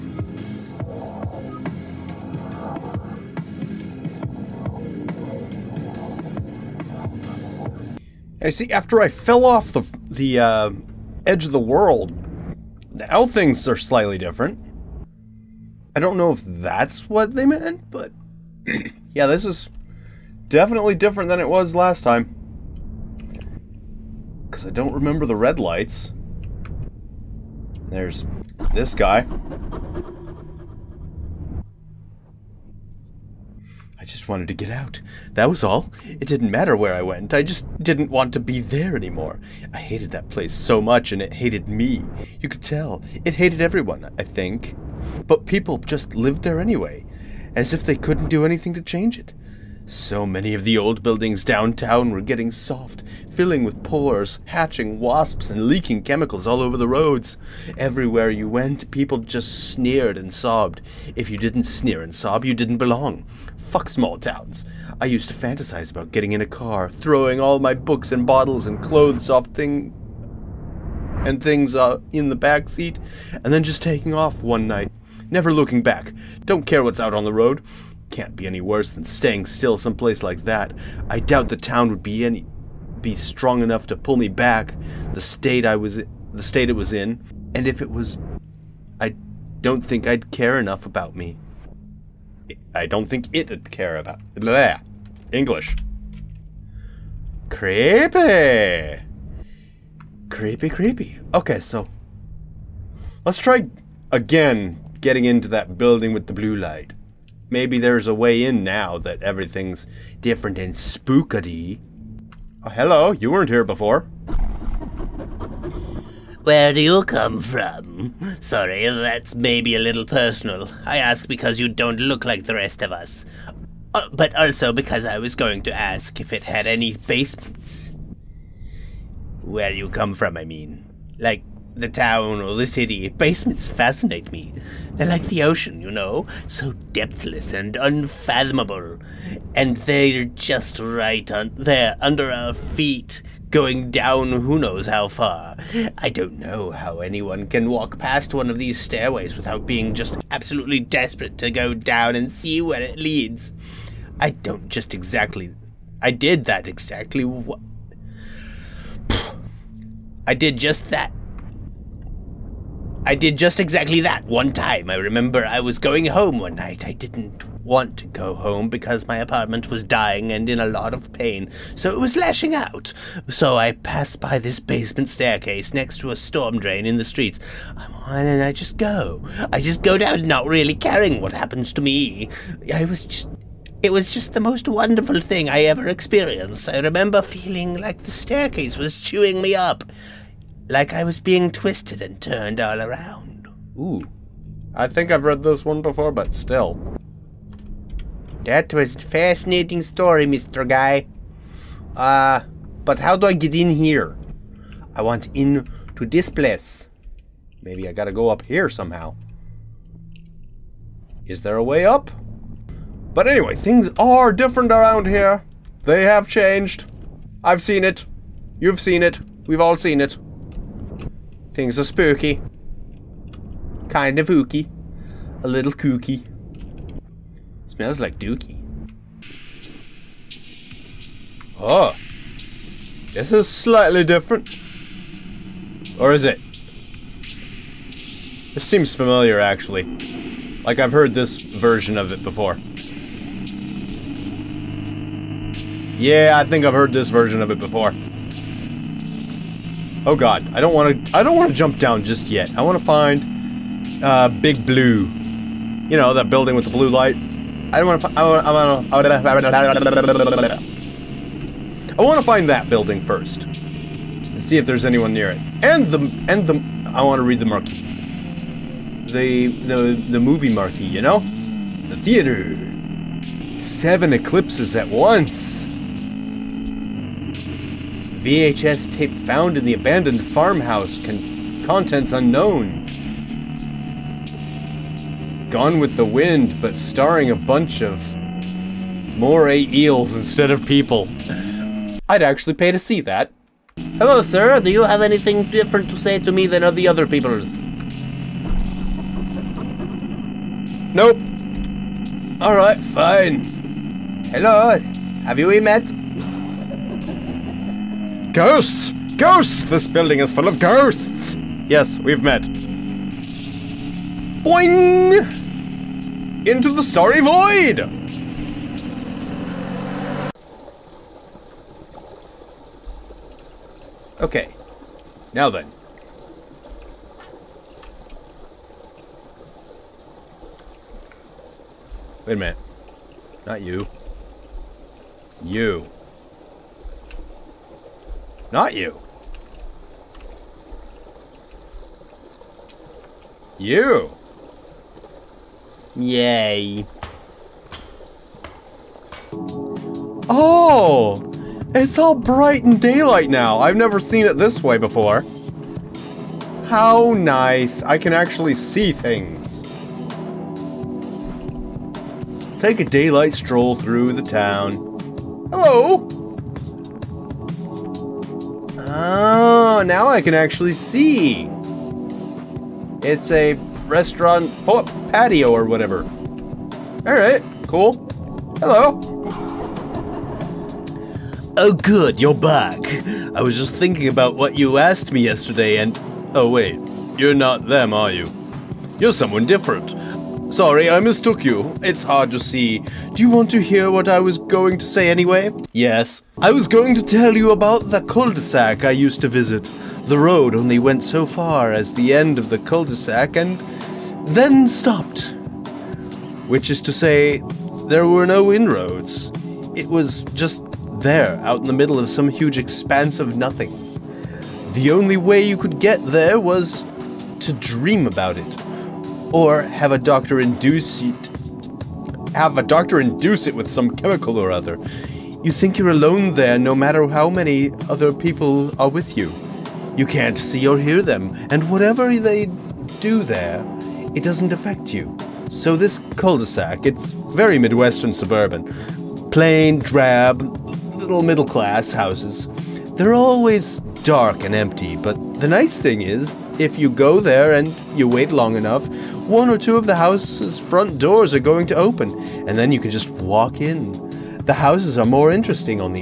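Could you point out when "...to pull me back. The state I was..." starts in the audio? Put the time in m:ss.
1:23.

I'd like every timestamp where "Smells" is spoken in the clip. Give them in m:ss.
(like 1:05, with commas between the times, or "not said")
3:47.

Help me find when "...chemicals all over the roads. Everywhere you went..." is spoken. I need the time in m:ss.
0:56.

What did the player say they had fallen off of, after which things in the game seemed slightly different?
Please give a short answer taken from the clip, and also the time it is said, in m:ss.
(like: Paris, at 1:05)
Edge of the World, at 0:11.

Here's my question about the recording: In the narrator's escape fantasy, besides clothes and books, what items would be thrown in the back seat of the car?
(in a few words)
bottles.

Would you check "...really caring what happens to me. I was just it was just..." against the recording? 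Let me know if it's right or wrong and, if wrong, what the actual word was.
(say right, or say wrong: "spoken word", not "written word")
right.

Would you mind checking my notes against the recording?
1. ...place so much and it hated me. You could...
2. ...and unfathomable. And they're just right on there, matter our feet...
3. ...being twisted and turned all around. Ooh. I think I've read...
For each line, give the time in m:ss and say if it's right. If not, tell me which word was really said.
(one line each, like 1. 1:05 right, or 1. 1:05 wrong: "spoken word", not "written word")
1. 0:40 right
2. 2:17 wrong: "under", not "matter"
3. 3:11 right.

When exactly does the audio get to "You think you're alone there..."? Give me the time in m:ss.
7:05.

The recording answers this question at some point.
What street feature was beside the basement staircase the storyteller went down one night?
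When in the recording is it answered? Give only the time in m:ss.
2:56.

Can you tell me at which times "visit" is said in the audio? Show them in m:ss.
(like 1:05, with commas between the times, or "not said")
6:39.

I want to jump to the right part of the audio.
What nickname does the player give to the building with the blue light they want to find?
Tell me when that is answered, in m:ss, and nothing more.
4:14.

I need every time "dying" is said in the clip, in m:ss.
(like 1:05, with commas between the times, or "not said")
2:49.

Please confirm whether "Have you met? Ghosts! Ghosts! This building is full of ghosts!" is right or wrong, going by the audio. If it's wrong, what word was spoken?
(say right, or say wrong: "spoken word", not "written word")
right.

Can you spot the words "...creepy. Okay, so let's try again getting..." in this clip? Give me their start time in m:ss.
1:40.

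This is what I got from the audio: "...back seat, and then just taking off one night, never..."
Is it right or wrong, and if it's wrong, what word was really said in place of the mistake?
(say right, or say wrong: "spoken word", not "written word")
right.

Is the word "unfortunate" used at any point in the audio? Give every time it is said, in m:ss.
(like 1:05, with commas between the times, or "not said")
not said.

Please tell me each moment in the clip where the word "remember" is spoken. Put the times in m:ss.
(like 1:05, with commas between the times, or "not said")
0:24, 2:44, 3:06.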